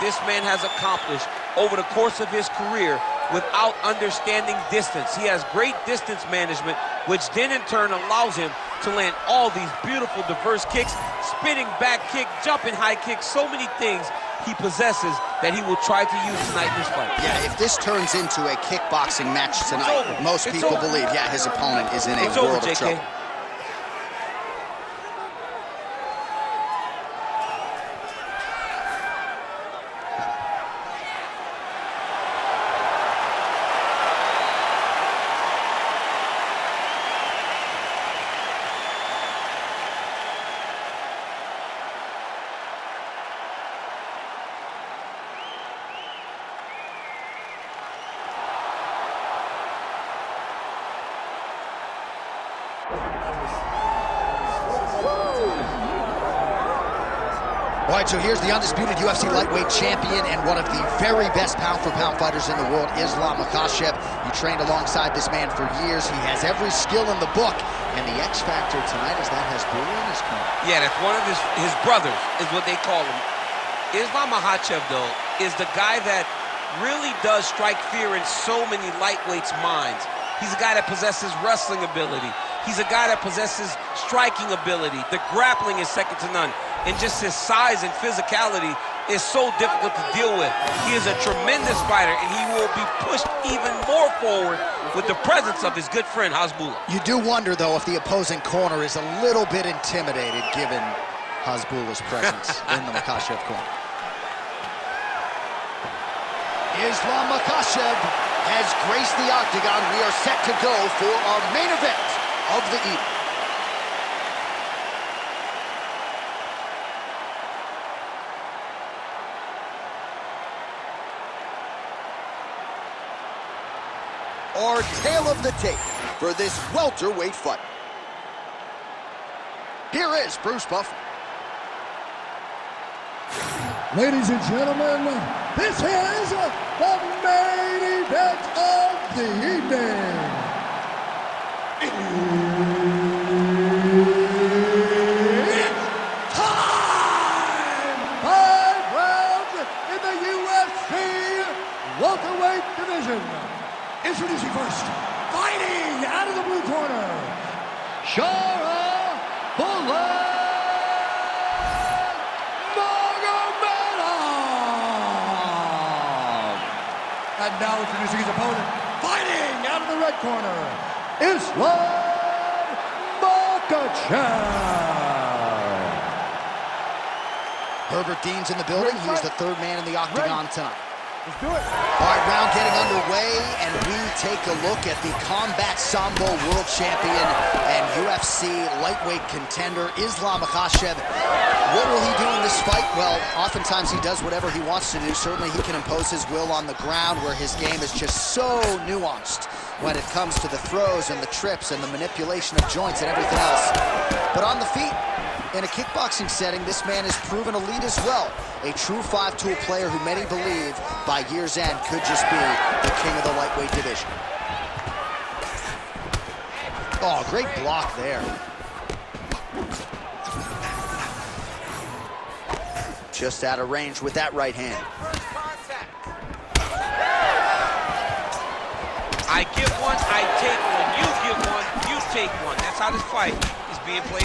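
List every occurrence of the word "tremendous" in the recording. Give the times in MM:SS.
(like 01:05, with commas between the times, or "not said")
01:31.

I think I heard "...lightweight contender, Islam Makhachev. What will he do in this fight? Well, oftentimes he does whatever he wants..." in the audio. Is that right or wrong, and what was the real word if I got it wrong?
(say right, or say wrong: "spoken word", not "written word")
right.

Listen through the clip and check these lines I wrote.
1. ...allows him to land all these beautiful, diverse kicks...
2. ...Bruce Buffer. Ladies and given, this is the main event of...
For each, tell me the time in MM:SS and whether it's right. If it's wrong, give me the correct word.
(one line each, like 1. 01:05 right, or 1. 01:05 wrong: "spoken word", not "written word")
1. 00:07 right
2. 02:10 wrong: "gentlemen", not "given".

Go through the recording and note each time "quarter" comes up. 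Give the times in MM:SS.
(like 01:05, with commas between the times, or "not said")
not said.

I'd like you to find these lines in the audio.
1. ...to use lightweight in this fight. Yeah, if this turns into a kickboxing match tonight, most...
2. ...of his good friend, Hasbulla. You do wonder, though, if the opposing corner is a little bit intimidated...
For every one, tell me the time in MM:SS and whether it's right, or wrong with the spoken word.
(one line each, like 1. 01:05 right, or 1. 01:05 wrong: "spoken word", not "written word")
1. 00:16 wrong: "tonight", not "lightweight"
2. 01:35 right.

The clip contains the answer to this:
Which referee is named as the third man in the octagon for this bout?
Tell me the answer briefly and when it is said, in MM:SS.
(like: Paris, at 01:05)
Herbert Dean, at 02:57.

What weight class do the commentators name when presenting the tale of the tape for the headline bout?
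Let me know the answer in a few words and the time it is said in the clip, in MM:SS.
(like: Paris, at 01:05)
Welterweight, at 02:06.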